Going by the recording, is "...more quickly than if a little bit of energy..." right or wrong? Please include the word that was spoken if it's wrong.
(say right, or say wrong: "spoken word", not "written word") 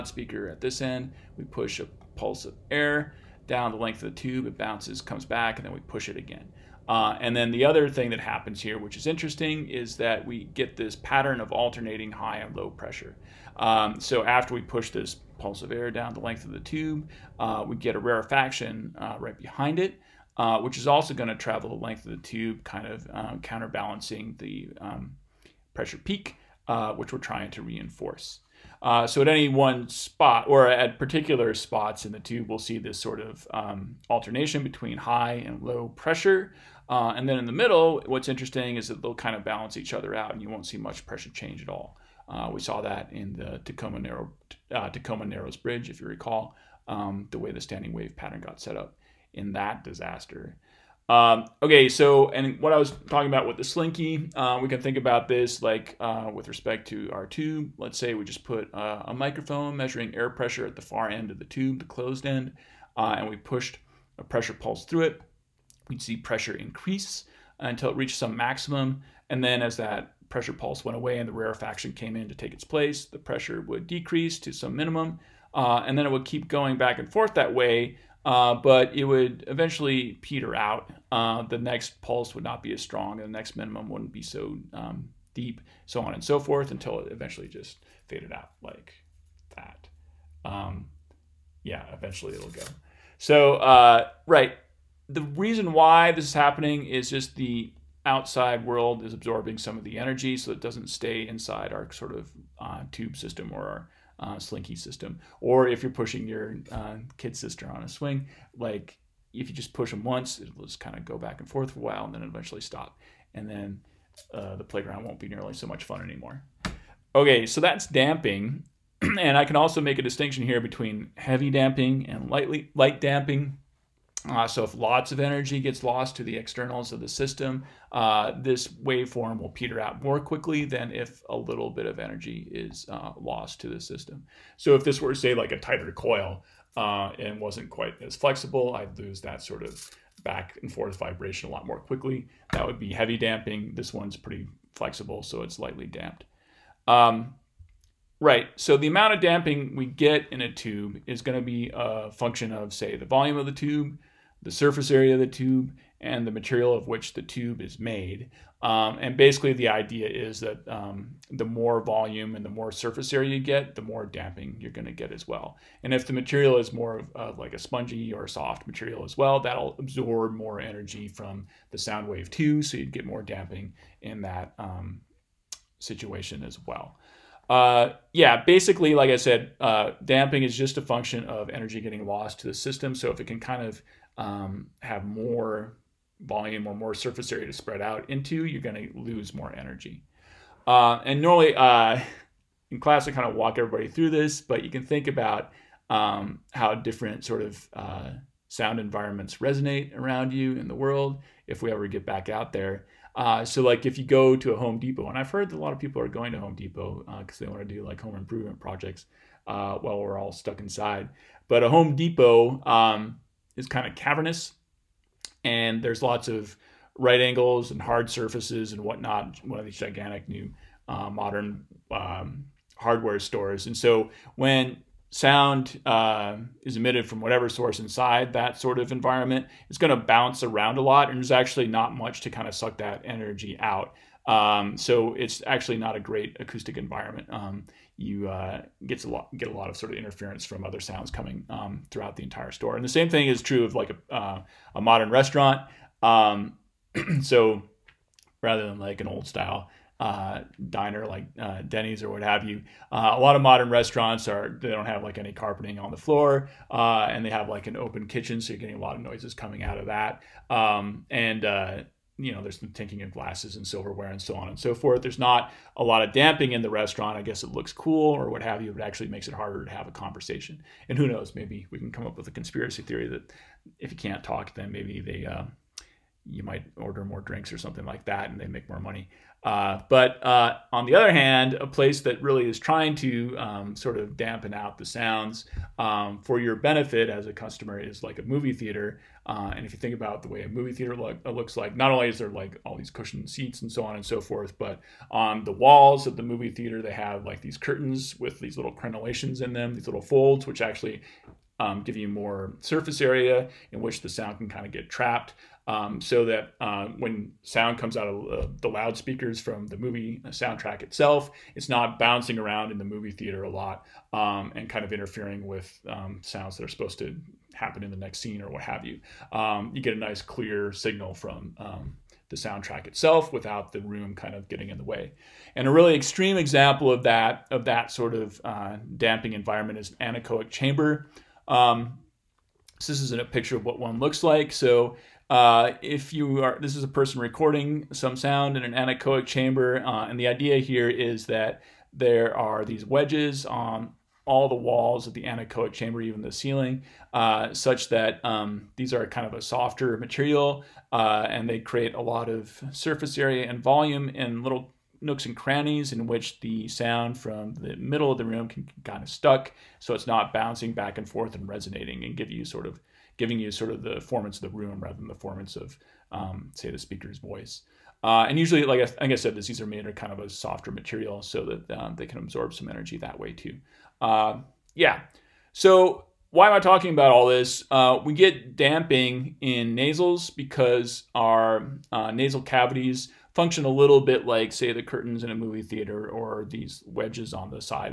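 right.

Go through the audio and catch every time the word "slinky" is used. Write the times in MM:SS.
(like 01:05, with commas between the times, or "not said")
00:53, 01:44.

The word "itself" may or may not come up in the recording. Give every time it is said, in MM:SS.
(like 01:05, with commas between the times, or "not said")
05:10, 05:22.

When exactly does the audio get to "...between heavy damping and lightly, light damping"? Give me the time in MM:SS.
02:00.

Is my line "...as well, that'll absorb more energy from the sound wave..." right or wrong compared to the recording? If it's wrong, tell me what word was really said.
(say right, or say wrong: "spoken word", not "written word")
right.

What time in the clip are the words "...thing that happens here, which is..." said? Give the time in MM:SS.
00:07.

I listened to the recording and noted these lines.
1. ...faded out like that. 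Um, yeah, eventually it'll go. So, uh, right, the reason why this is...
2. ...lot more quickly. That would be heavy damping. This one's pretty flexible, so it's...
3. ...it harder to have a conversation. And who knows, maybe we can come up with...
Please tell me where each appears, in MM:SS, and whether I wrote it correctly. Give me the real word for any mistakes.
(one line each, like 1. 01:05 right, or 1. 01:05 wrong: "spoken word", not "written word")
1. 01:28 right
2. 02:21 right
3. 04:29 right.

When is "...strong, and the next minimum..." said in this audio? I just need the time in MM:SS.
01:22.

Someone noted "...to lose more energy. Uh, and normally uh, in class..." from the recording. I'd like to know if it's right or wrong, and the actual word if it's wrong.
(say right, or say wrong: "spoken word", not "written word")
right.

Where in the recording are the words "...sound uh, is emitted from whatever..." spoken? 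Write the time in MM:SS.
03:45.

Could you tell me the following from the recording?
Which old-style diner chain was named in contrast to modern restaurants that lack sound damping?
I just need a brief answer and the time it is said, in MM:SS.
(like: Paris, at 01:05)
Denny's, at 04:11.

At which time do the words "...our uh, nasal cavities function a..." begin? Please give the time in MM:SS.
06:21.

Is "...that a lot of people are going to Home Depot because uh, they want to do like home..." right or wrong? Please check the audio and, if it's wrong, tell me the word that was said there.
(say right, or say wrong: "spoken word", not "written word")
right.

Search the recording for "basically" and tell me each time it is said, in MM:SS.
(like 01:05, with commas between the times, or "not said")
02:39, 02:58.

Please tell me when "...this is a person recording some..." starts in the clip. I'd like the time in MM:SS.
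05:36.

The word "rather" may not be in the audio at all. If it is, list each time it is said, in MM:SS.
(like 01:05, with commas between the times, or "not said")
04:08, 06:04.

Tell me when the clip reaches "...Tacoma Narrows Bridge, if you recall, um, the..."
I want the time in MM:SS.
00:44.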